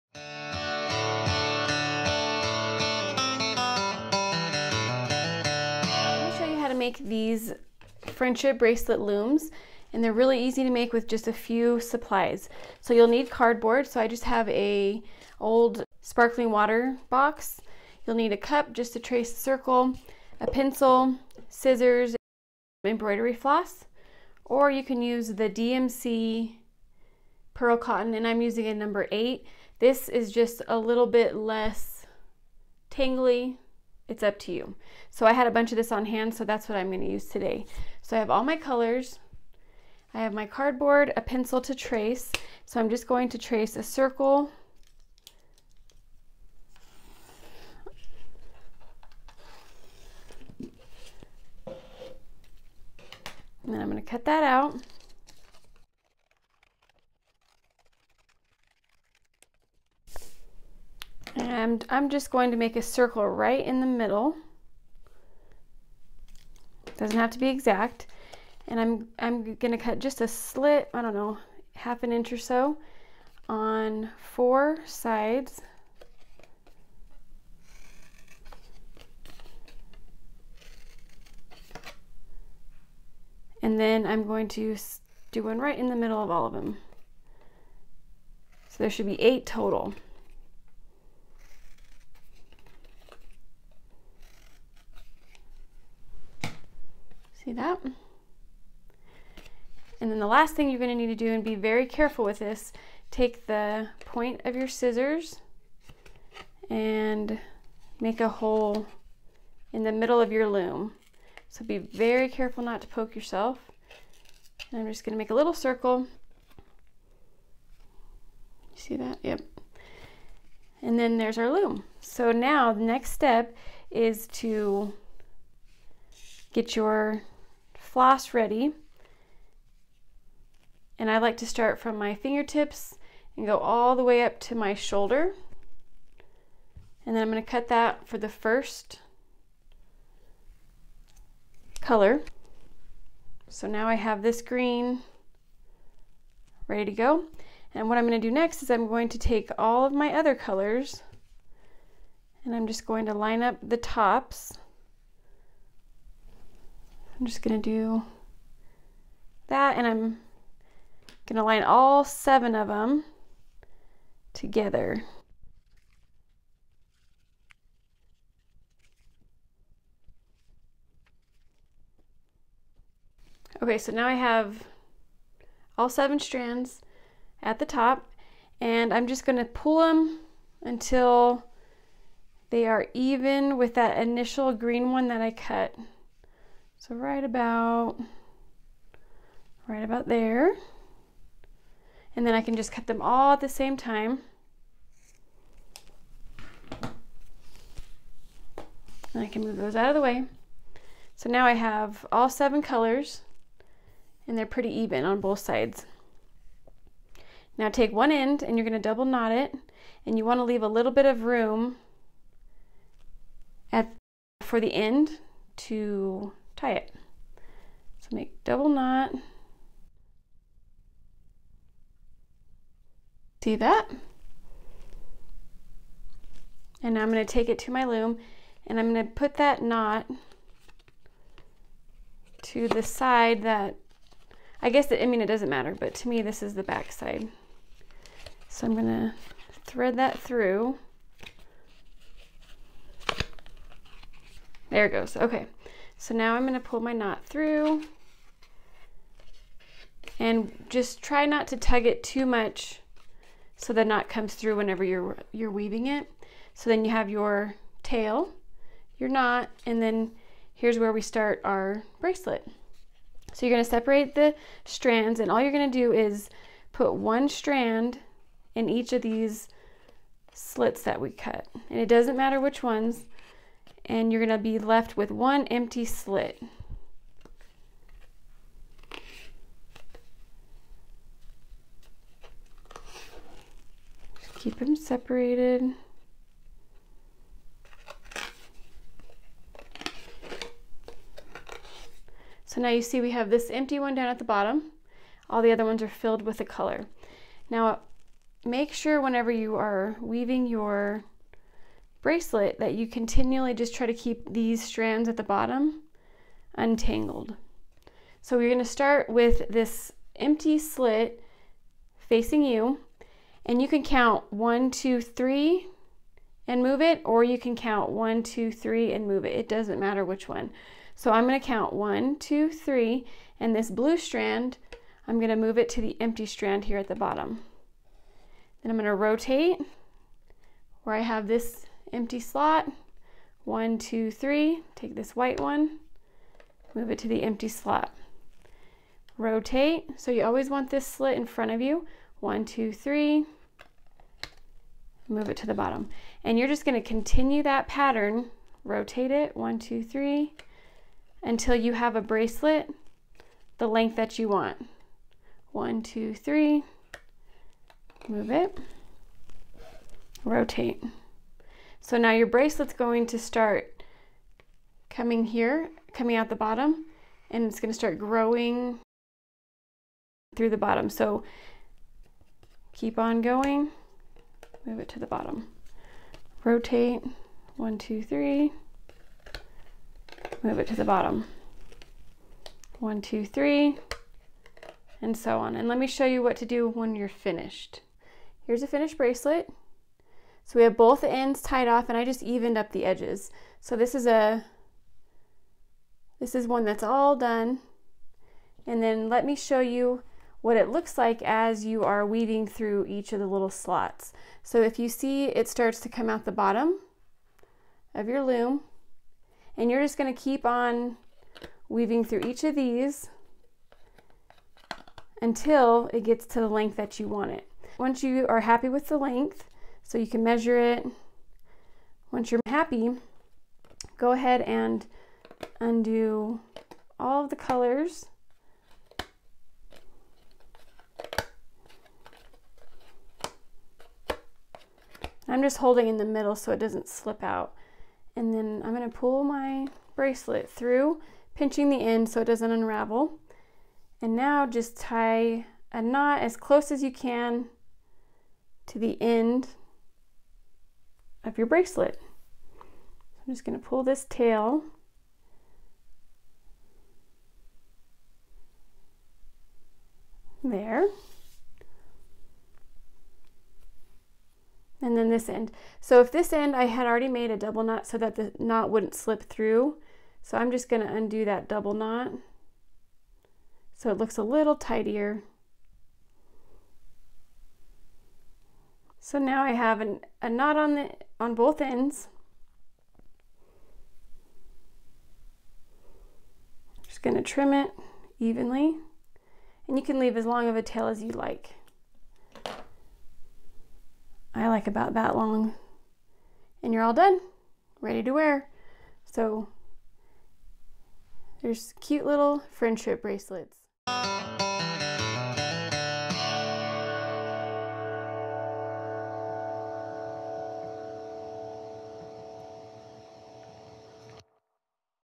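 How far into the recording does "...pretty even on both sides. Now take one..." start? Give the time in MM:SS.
03:24.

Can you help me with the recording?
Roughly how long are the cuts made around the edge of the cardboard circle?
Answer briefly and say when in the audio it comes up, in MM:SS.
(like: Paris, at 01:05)
Half an inch, at 01:11.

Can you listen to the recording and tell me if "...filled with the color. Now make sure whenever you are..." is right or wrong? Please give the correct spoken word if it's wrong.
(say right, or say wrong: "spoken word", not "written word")
right.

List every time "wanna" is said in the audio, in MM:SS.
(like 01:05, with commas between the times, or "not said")
03:30.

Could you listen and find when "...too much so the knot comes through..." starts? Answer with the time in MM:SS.
04:12.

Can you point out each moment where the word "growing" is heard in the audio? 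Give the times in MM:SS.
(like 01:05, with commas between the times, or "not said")
06:07.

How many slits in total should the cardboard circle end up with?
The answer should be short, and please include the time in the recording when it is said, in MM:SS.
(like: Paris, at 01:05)
8, at 01:29.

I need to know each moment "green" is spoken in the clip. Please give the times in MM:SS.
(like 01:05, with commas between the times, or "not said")
02:24, 03:04.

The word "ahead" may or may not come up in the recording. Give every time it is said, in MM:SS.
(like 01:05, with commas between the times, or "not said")
07:04.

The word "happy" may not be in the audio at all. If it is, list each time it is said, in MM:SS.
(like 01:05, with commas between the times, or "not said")
06:58, 07:02.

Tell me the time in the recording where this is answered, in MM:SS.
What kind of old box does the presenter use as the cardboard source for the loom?
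00:16.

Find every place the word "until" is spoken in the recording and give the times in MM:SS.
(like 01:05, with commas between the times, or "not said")
03:00, 05:51, 06:55.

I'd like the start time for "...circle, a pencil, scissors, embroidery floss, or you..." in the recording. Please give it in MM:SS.
00:19.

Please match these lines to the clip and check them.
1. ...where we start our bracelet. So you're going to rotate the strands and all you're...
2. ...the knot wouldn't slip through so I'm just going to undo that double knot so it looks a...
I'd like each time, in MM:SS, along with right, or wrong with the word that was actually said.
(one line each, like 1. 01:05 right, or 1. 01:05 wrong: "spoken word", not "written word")
1. 04:20 wrong: "separate", not "rotate"
2. 07:48 right.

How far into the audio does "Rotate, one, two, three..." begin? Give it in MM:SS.
06:16.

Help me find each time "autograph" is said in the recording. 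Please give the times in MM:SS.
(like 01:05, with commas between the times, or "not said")
not said.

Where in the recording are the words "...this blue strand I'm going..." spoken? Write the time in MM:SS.
05:23.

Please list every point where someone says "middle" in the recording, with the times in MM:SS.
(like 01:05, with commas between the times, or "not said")
01:03, 01:25, 01:49, 07:16.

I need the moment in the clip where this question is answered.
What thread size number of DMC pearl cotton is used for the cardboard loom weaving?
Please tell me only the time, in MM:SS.
00:28.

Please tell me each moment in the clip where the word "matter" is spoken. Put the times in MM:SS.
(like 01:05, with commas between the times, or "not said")
03:55, 04:32, 05:19.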